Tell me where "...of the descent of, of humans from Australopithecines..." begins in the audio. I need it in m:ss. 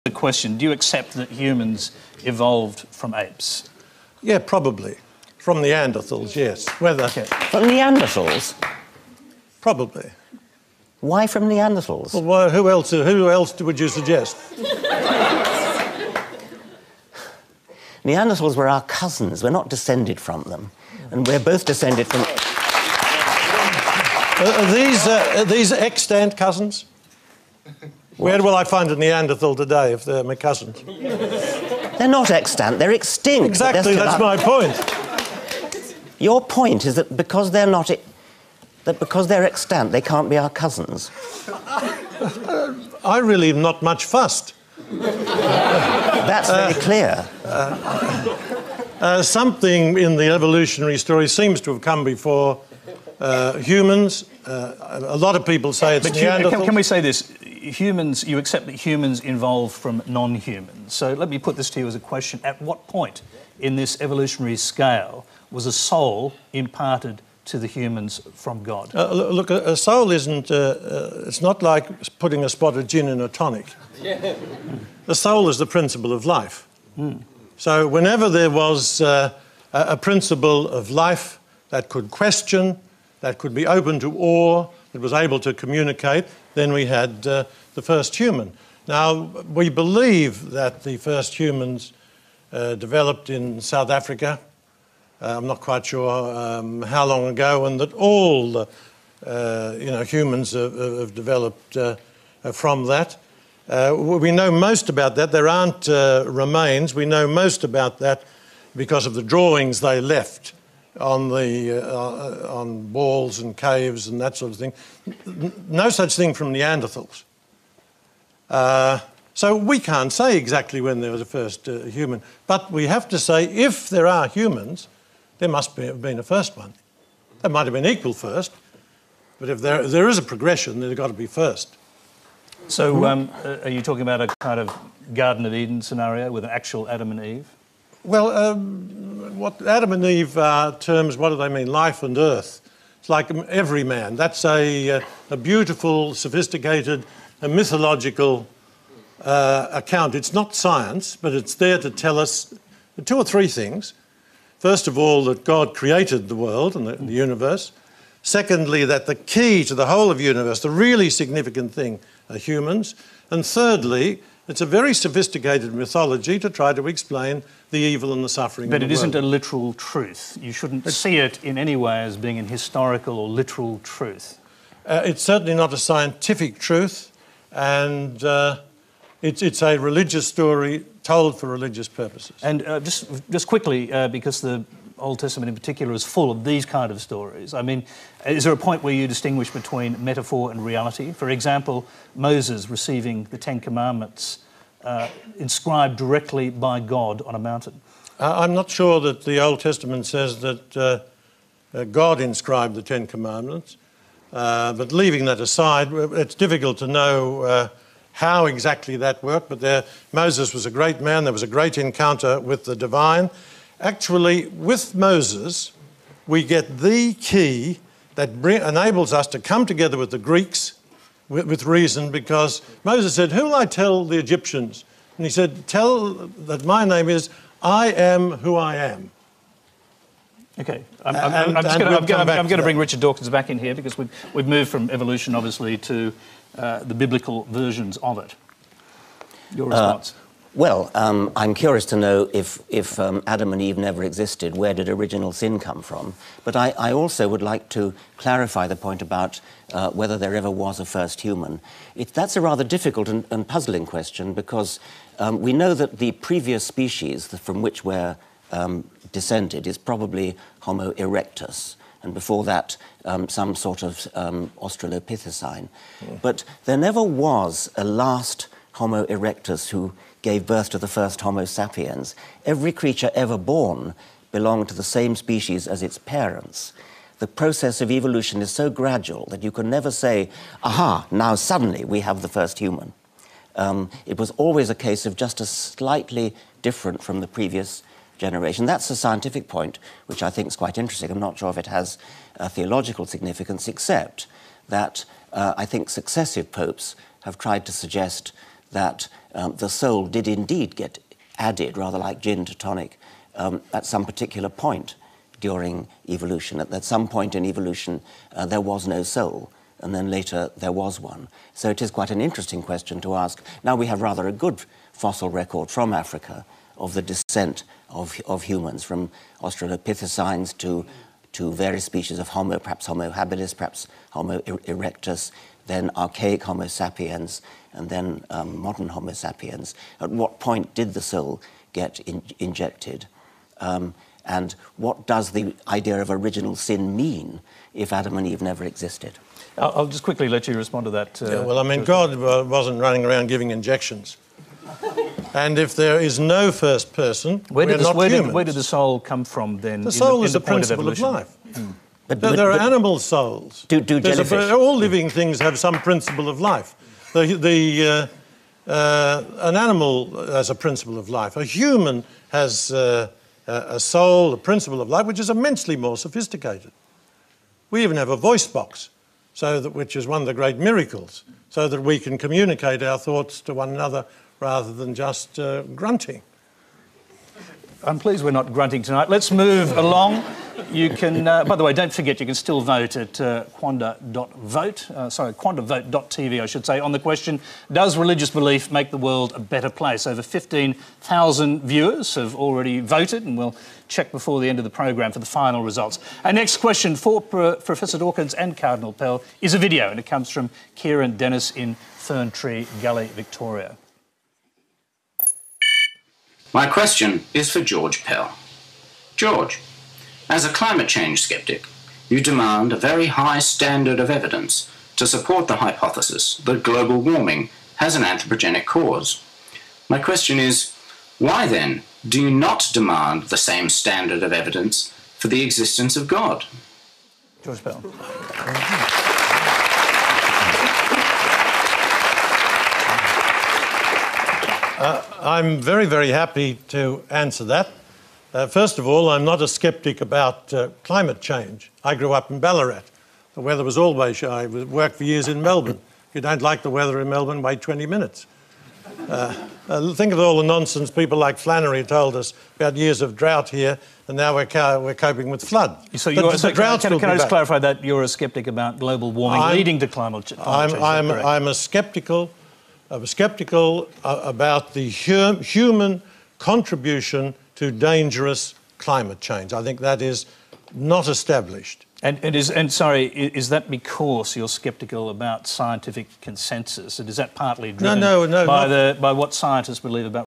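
5:16.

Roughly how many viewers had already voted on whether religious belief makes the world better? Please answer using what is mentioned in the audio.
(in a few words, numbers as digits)
Over 15,000.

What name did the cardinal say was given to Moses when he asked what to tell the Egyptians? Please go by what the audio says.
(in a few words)
I am who I am.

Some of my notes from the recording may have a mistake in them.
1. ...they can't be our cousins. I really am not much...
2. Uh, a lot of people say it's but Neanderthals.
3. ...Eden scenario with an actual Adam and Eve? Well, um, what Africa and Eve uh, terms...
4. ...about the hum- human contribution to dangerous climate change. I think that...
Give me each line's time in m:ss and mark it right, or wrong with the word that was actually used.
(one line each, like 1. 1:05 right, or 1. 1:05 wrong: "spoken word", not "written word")
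1. 0:39 right
2. 0:54 right
3. 2:15 wrong: "Adam", not "Africa"
4. 7:44 right.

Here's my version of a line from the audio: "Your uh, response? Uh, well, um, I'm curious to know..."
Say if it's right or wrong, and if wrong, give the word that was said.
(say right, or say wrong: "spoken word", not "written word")
right.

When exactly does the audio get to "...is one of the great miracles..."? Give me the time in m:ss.
6:09.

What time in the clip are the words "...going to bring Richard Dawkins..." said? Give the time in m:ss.
3:52.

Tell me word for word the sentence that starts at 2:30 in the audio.
It's not science, but it's there to tell us two or three things.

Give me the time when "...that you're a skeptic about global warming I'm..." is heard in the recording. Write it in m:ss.
7:37.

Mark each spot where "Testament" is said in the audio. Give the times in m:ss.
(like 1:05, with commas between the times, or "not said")
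3:05, 3:19.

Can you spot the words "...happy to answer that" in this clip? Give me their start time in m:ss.
7:16.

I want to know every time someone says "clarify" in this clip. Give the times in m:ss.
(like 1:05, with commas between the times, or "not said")
4:08, 7:37.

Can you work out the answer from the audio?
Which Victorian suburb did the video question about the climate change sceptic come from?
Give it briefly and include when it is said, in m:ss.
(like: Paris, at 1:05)
Ferntree Gully, at 6:41.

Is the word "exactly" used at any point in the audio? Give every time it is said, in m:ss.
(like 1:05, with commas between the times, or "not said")
0:33, 2:00, 3:28.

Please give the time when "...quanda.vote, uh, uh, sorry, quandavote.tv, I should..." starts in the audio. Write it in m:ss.
6:23.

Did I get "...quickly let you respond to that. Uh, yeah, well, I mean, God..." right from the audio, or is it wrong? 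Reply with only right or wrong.
right.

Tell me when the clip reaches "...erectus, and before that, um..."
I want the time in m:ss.
4:20.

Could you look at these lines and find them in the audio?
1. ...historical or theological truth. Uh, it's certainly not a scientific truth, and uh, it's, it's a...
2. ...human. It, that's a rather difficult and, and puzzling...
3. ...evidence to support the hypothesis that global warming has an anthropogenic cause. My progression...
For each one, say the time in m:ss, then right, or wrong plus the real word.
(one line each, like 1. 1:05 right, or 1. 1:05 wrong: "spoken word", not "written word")
1. 2:52 wrong: "literal", not "theological"
2. 4:11 right
3. 6:54 wrong: "question", not "progression".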